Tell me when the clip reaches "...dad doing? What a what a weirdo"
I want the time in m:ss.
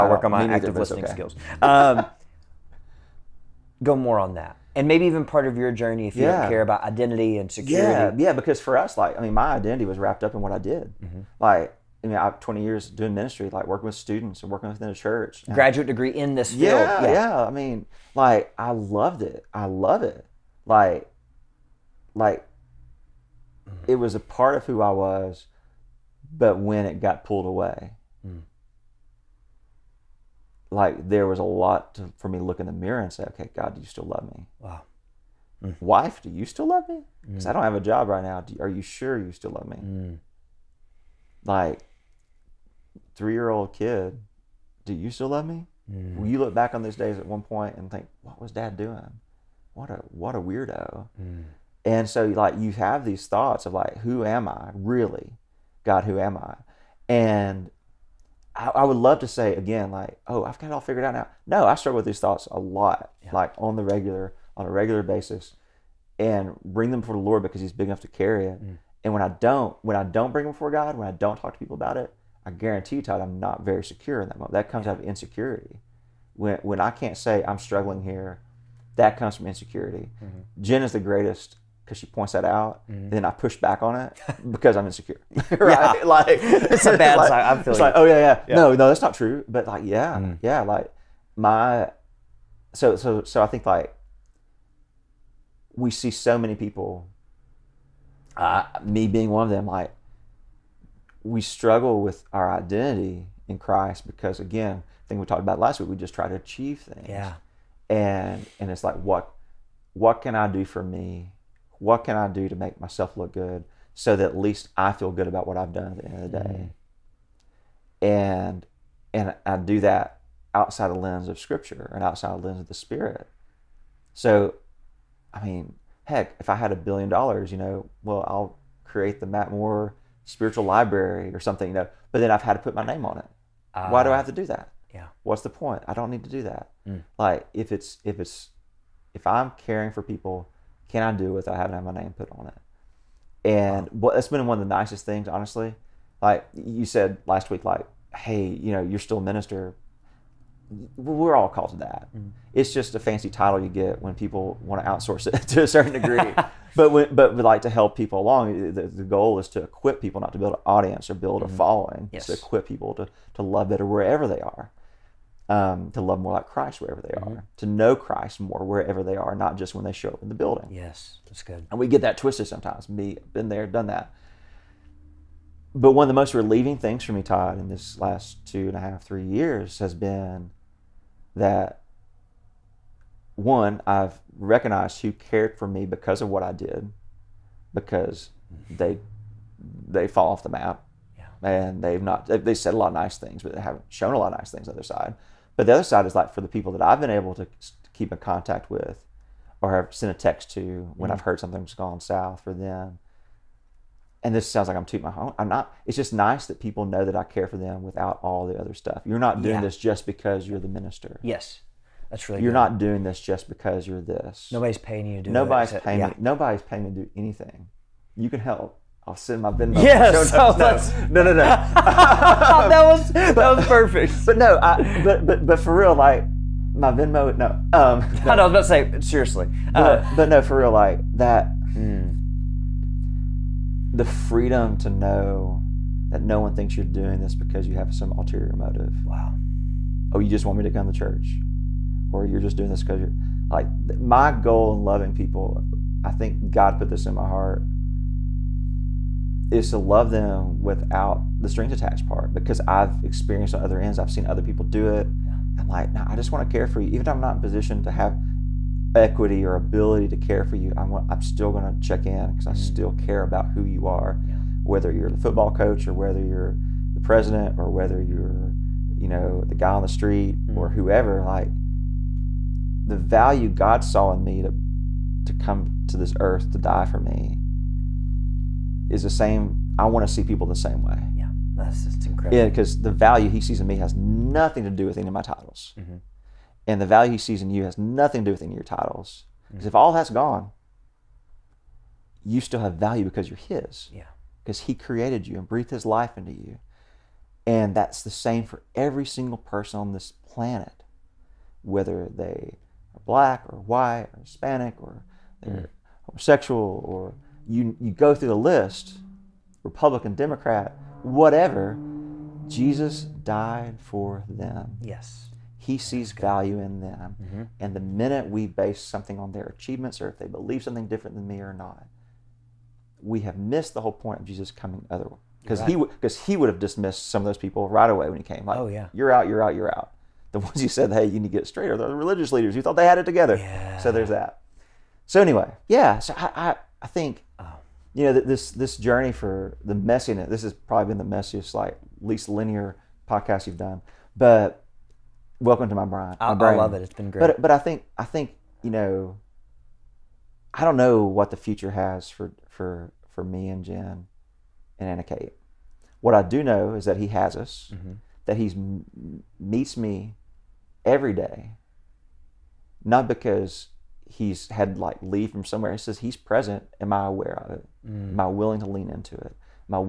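0:48.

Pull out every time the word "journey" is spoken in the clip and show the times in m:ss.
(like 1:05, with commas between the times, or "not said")
0:05, 5:38.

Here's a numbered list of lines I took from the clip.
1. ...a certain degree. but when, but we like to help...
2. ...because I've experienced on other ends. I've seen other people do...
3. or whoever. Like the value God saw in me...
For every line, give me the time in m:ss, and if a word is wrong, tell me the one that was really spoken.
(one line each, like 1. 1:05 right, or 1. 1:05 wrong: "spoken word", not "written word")
1. 2:35 right
2. 4:12 right
3. 4:30 right.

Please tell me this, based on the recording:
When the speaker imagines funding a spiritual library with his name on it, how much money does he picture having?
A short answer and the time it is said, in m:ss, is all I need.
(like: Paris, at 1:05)
a billion dollars, at 2:06.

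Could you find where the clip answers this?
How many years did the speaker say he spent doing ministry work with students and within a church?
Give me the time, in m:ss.
0:12.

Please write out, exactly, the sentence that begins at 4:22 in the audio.
still care about who you are, yeah.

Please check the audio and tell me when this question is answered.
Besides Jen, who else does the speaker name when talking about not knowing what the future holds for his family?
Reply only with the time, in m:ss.
5:54.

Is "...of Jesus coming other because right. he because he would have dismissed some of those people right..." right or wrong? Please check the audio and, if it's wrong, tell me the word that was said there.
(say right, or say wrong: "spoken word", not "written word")
right.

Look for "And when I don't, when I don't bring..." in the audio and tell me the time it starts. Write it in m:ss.
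1:09.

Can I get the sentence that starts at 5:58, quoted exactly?
That he's meets me every day.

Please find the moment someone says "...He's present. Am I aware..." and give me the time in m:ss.
6:05.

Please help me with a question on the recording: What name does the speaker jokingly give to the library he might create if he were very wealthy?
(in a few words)
Matt Moore spiritual library.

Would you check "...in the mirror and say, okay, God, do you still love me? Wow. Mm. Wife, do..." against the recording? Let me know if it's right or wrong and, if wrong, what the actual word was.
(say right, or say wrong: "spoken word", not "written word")
right.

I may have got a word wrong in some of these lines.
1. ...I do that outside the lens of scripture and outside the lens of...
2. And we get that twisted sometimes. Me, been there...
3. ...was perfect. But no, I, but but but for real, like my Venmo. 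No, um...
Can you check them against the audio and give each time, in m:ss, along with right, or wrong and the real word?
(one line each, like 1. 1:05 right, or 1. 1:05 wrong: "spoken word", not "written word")
1. 1:59 right
2. 2:51 right
3. 3:43 right.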